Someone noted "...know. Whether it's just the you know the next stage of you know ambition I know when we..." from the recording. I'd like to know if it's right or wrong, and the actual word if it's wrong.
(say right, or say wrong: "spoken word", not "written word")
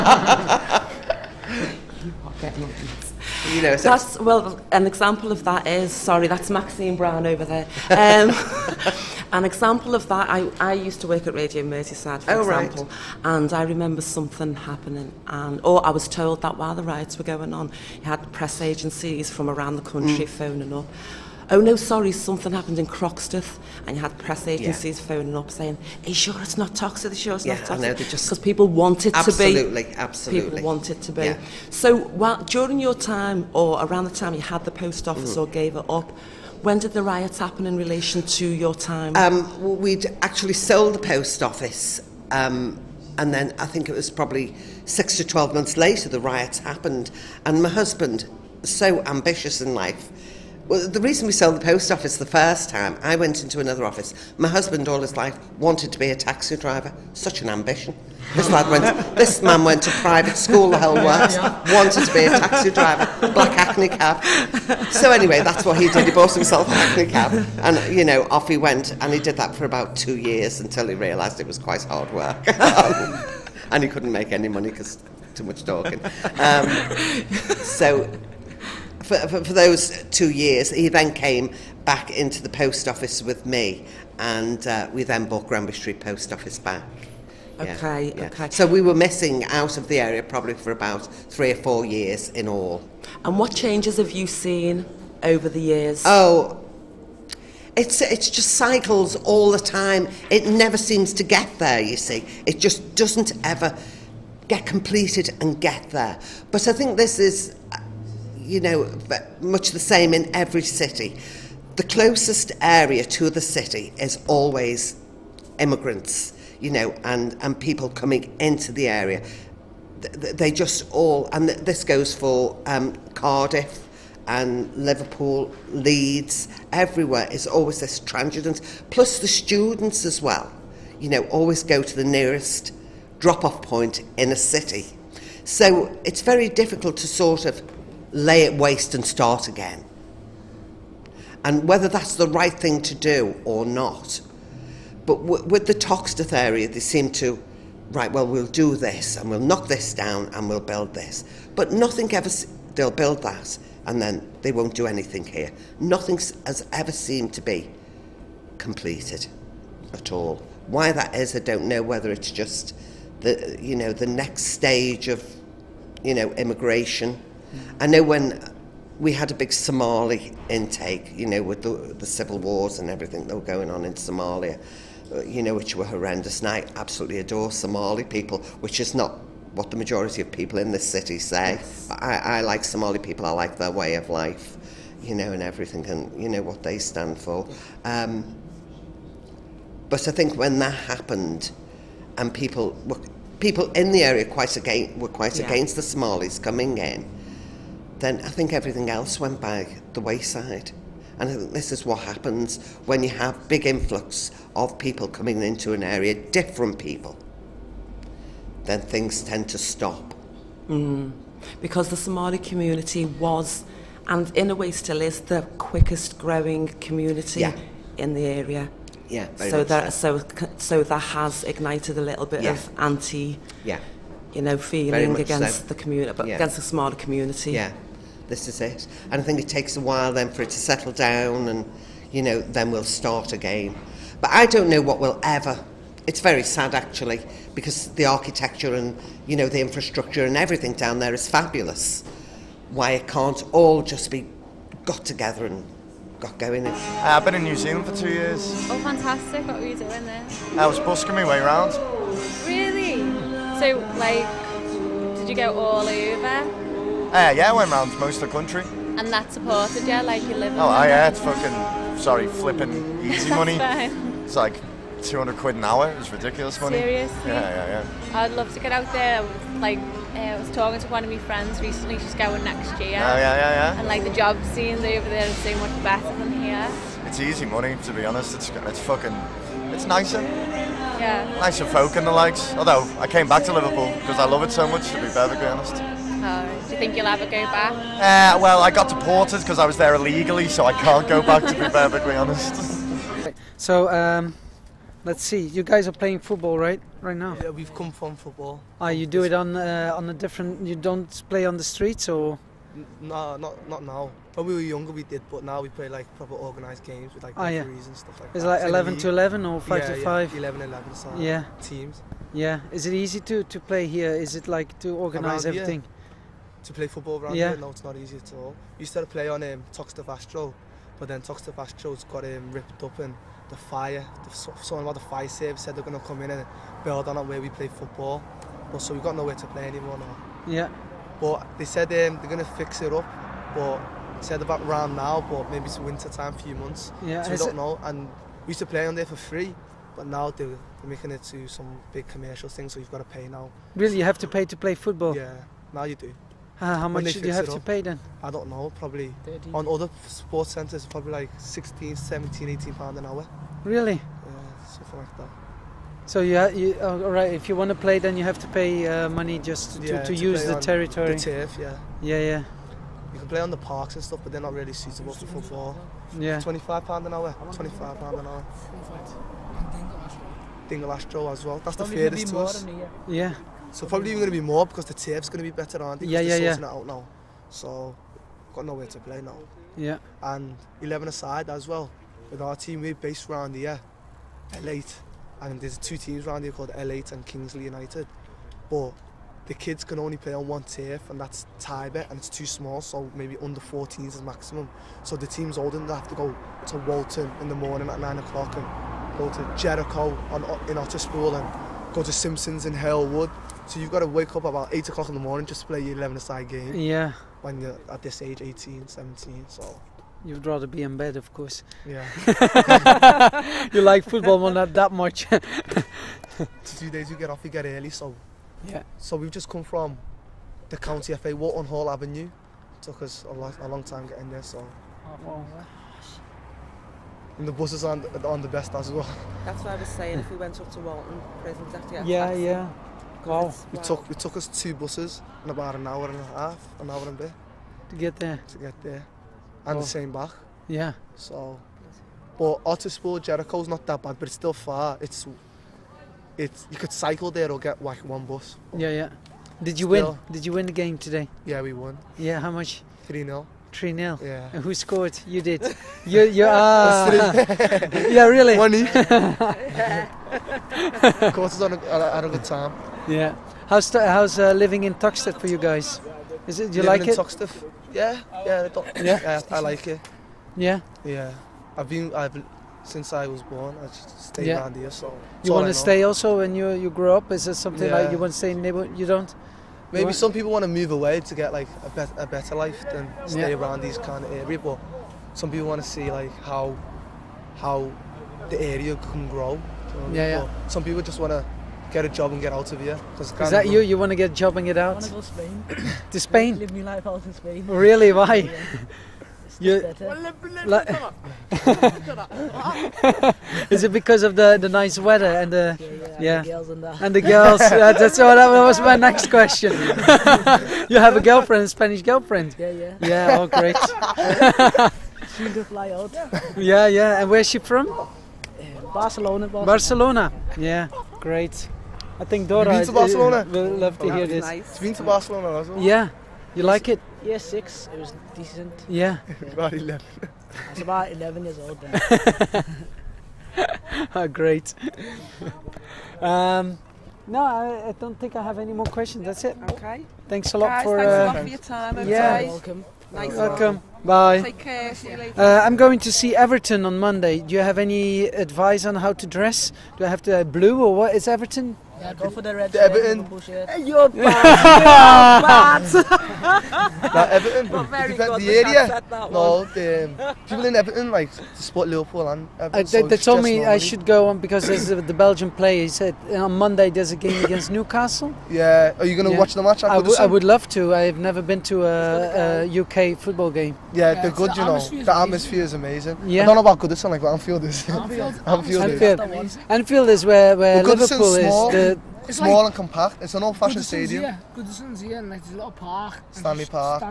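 wrong: "immigration", not "ambition".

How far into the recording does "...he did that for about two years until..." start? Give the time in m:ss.
1:09.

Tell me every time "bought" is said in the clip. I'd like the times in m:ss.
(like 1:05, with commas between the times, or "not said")
1:06, 1:25.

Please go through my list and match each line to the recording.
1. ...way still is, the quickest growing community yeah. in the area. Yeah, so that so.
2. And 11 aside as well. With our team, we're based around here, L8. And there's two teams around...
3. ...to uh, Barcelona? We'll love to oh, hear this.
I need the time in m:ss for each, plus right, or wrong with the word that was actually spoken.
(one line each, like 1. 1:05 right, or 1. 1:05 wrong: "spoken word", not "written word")
1. 3:34 right
2. 6:20 right
3. 8:42 right.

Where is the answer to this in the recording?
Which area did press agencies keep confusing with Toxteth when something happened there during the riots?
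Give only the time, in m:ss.
0:22.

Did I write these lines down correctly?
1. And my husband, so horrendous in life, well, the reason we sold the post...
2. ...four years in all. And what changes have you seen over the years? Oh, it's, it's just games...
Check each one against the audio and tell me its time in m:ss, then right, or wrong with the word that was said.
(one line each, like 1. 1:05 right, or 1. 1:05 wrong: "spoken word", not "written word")
1. 0:47 wrong: "ambitious", not "horrendous"
2. 1:31 wrong: "cycles", not "games".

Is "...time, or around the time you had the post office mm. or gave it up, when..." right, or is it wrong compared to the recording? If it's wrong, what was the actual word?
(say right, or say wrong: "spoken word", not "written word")
right.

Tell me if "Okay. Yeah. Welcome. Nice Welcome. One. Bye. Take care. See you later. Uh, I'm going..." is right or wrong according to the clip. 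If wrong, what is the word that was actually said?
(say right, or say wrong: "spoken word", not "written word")
right.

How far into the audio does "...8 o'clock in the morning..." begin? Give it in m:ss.
6:44.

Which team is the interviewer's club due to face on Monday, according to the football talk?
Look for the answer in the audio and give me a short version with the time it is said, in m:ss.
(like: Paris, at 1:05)
Newcastle, at 9:27.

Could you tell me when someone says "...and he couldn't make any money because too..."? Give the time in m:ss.
1:13.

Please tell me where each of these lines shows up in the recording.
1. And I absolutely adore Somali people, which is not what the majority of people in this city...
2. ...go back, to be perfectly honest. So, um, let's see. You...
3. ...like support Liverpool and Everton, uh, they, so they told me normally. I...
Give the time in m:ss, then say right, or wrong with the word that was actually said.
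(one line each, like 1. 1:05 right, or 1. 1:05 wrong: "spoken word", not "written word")
1. 2:56 right
2. 4:51 right
3. 9:21 right.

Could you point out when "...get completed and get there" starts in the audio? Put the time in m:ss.
1:44.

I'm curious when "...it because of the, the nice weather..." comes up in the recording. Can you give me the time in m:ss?
8:23.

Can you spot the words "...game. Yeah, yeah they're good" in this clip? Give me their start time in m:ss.
9:33.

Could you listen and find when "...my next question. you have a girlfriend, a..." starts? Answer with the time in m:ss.
8:28.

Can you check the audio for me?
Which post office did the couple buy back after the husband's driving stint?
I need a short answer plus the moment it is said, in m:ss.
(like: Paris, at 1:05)
Granby Street Post Office, at 1:25.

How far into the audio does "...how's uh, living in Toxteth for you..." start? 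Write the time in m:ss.
7:43.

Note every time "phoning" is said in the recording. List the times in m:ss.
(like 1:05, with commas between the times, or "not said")
0:20, 0:25.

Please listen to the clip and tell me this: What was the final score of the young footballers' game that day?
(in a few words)
3-0.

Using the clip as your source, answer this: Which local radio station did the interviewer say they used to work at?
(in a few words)
Radio Merseyside.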